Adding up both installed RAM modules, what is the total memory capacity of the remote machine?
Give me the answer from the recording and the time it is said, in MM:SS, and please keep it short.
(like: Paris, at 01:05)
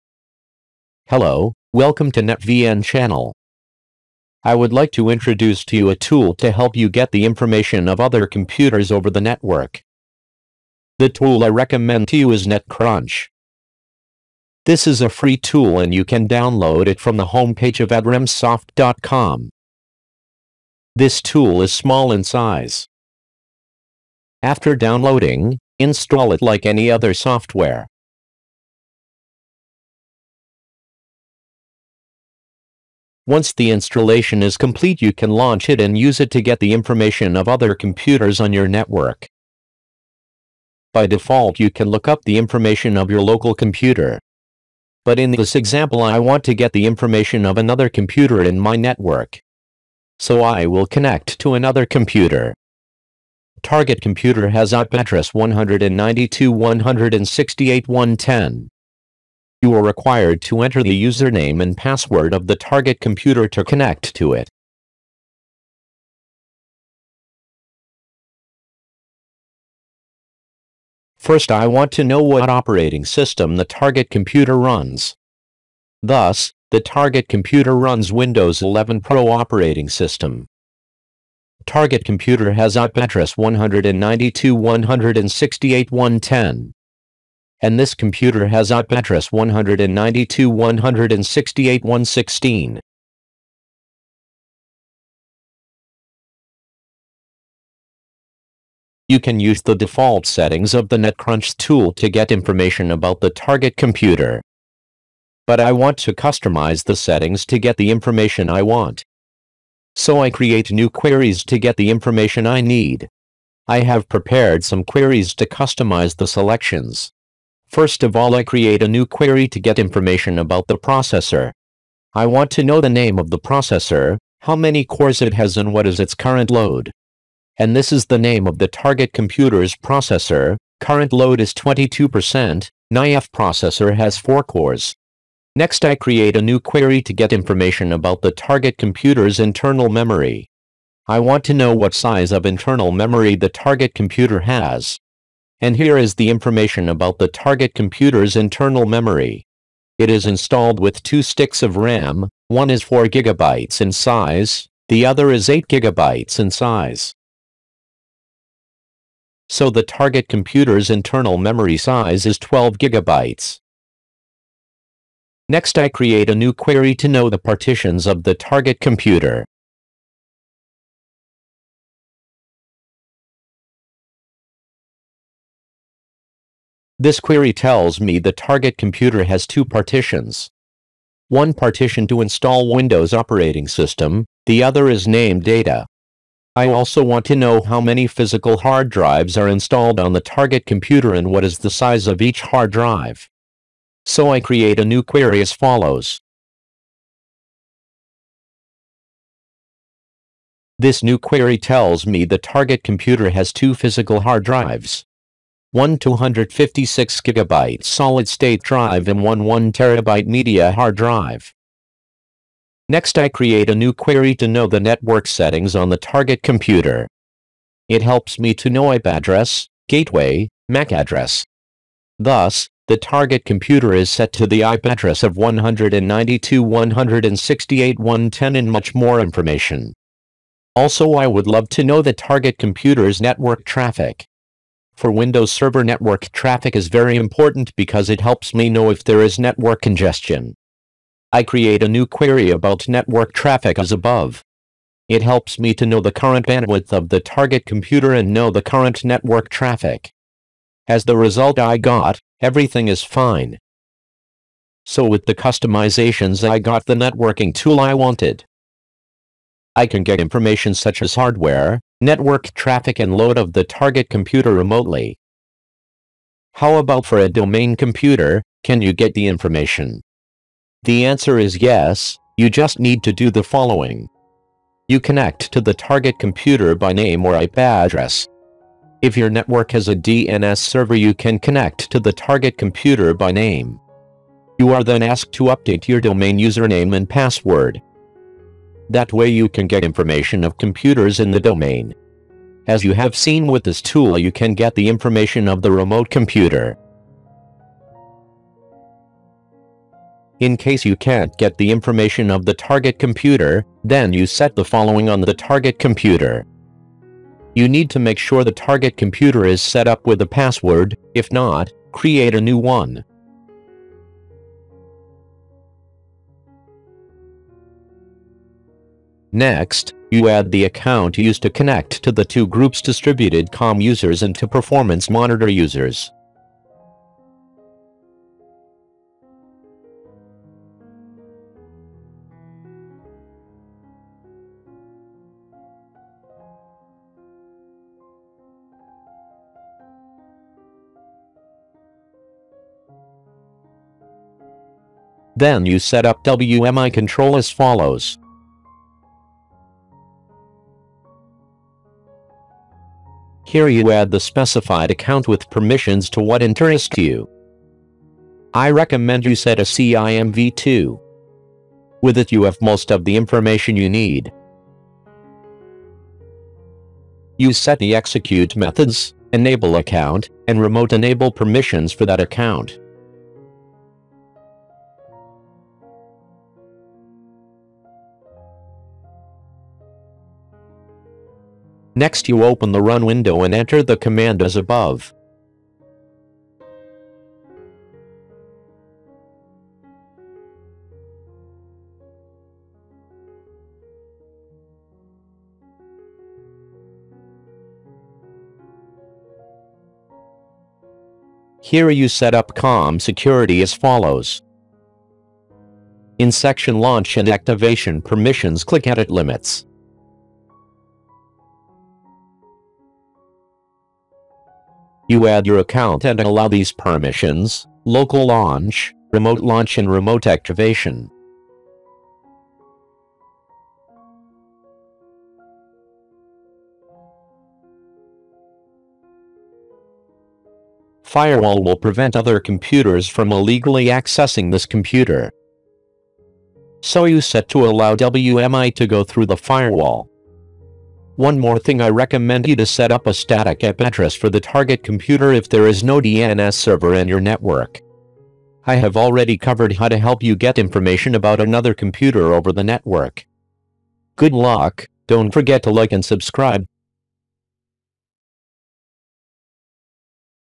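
12 GB, at 02:42.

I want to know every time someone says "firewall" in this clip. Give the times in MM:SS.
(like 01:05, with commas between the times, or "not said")
07:11, 07:19.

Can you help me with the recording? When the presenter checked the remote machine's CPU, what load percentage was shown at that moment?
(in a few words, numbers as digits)
22%.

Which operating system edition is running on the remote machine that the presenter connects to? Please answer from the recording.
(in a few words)
Windows 11 Pro.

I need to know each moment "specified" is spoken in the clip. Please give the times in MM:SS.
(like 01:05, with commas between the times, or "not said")
05:54.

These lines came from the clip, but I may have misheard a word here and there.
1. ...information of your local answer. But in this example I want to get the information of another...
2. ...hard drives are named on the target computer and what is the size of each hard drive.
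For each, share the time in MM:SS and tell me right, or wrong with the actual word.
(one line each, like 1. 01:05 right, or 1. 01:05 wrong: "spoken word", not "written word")
1. 00:42 wrong: "computer", not "answer"
2. 03:08 wrong: "installed", not "named".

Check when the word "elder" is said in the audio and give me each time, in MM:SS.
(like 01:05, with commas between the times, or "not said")
not said.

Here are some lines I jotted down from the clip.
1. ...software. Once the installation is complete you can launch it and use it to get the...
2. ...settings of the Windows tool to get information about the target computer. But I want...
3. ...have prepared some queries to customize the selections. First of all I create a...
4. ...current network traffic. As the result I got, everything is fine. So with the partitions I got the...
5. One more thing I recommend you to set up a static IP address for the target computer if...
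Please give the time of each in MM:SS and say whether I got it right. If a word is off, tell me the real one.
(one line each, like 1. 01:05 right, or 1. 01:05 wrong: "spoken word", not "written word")
1. 00:27 right
2. 01:40 wrong: "NetCrunch", not "Windows"
3. 01:53 right
4. 04:08 wrong: "customizations", not "partitions"
5. 07:21 right.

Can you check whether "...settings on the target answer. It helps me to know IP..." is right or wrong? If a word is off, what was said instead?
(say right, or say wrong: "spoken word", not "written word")
wrong: "computer", not "answer".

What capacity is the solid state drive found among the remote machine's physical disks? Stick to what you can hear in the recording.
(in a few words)
256 gigabyte.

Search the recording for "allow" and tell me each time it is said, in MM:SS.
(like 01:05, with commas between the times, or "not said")
06:56, 07:17.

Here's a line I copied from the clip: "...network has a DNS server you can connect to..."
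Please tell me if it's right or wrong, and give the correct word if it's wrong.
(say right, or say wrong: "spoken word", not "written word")
right.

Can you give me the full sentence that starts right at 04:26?
How about for a domain computer, can you get the information?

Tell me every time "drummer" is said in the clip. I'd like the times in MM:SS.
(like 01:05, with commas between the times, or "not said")
not said.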